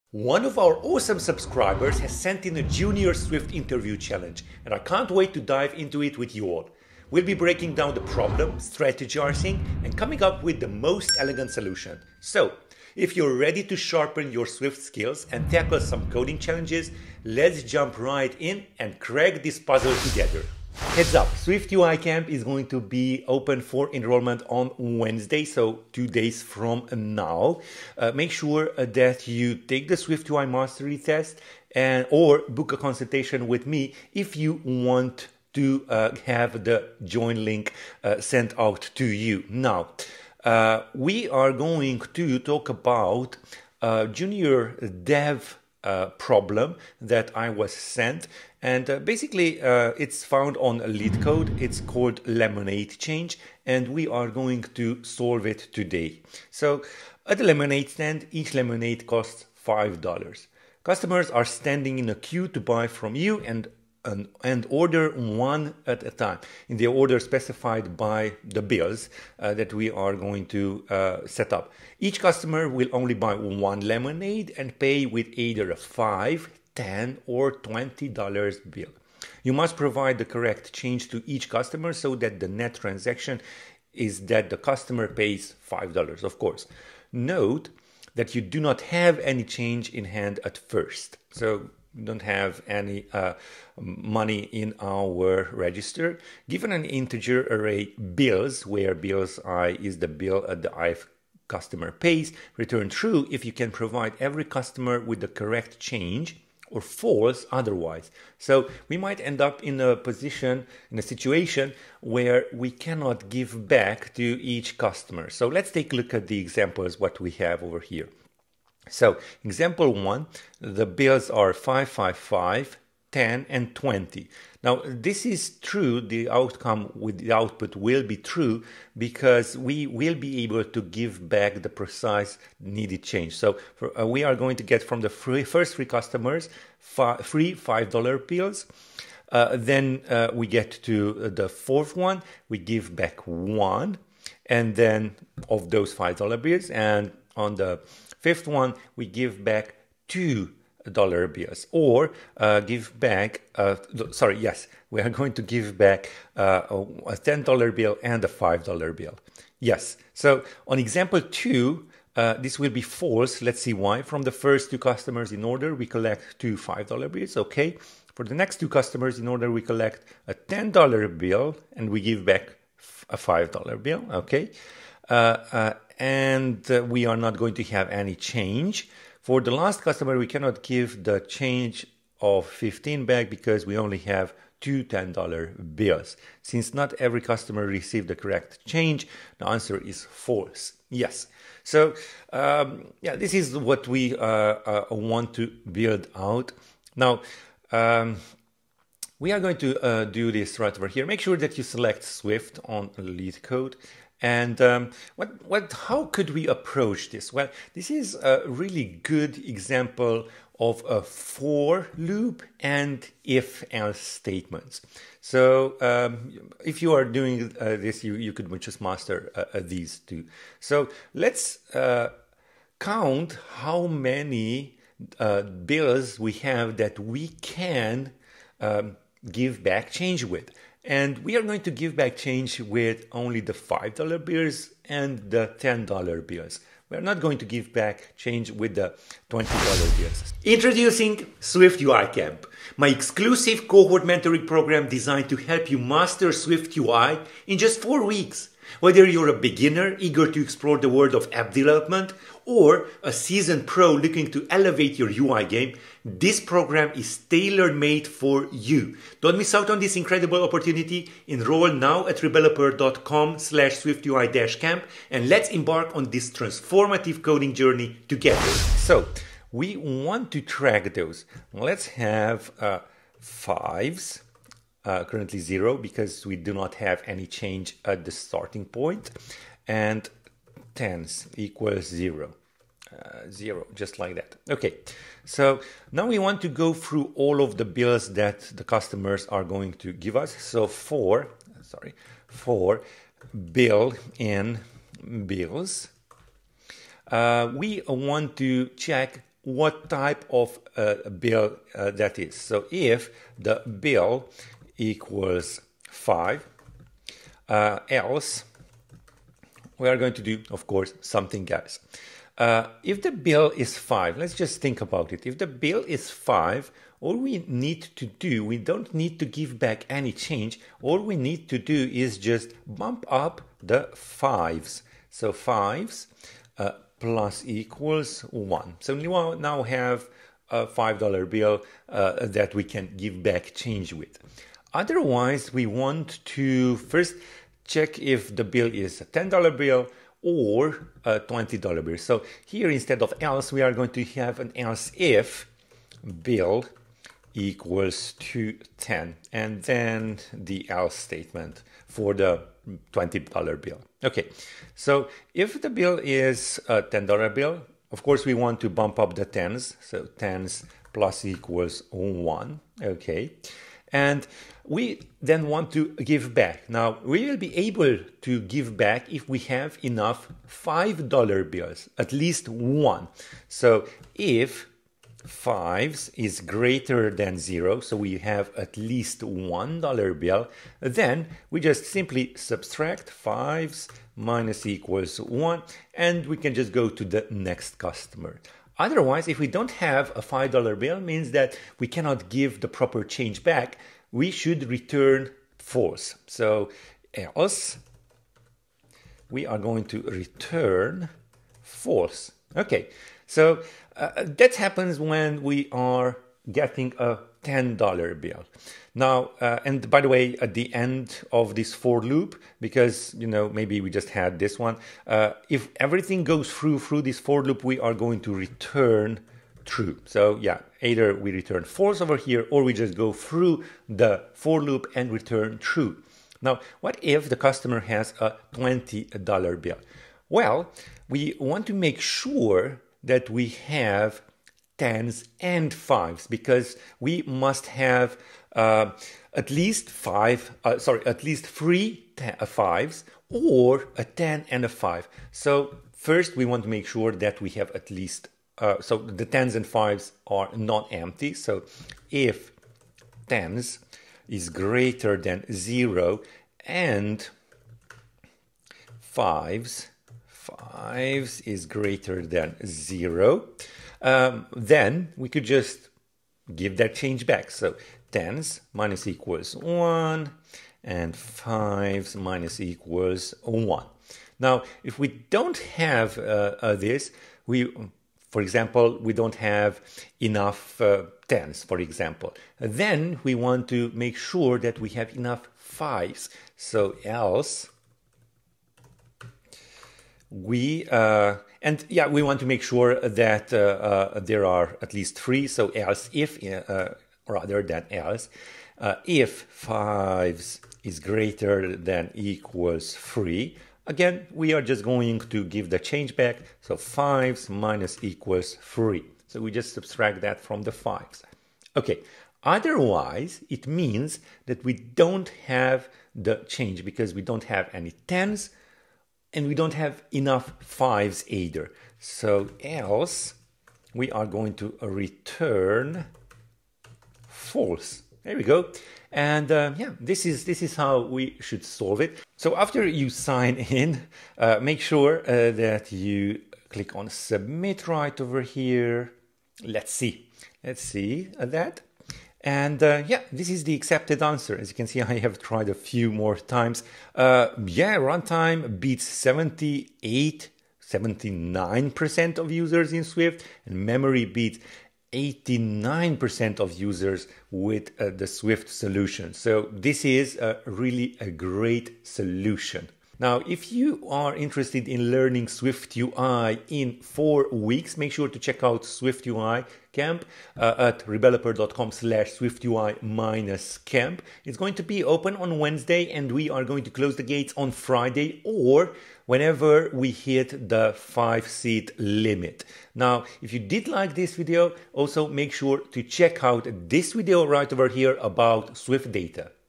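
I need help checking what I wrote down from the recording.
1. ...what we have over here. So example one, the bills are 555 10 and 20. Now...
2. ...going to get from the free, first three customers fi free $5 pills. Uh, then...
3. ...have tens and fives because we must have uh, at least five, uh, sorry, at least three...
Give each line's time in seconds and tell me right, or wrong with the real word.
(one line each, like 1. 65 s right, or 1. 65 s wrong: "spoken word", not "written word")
1. 116 s right
2. 134 s right
3. 433 s right.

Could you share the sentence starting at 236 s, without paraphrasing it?
We're not going to give back change with the $20 bills.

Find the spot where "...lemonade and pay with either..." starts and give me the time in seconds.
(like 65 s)
73 s.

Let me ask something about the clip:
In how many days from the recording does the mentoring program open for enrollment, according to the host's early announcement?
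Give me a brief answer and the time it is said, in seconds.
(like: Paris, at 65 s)
2 days, at 25 s.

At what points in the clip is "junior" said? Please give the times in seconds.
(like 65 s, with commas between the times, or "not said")
2 s, 44 s.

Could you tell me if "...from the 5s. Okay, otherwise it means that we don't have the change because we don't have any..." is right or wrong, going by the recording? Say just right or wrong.
right.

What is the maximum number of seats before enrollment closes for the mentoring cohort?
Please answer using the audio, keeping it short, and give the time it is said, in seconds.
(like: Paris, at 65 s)
5, at 580 s.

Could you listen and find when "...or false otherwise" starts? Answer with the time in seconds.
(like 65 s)
106 s.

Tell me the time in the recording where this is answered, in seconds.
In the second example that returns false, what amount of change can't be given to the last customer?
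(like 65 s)
182 s.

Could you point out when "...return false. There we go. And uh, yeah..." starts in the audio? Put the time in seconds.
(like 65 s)
524 s.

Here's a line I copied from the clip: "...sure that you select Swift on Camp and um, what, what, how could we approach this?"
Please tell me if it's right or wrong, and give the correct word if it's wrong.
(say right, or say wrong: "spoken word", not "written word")
wrong: "LeetCode", not "Camp".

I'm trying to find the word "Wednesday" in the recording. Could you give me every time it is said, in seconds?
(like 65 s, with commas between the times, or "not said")
24 s, 575 s.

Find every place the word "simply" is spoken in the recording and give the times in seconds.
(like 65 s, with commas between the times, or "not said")
381 s.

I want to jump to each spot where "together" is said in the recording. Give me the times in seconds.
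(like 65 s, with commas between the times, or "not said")
20 s, 268 s.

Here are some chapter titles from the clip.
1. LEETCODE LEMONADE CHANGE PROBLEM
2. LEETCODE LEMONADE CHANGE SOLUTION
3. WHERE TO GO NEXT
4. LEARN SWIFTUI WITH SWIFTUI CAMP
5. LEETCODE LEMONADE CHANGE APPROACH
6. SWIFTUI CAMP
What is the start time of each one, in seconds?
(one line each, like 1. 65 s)
1. 40 s
2. 268 s
3. 563 s
4. 240 s
5. 205 s
6. 20 s.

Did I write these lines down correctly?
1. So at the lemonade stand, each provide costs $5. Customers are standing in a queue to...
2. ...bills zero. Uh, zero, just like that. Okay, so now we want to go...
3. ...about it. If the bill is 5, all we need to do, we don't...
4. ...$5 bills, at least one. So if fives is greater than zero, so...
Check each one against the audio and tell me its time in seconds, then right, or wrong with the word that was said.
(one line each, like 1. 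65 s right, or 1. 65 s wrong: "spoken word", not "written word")
1. 56 s wrong: "lemonade", not "provide"
2. 281 s wrong: "equals", not "bills"
3. 314 s right
4. 370 s right.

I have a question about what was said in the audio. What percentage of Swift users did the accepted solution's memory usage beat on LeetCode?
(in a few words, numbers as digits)
89%.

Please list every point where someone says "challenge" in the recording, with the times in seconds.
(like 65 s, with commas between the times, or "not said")
3 s, 16 s.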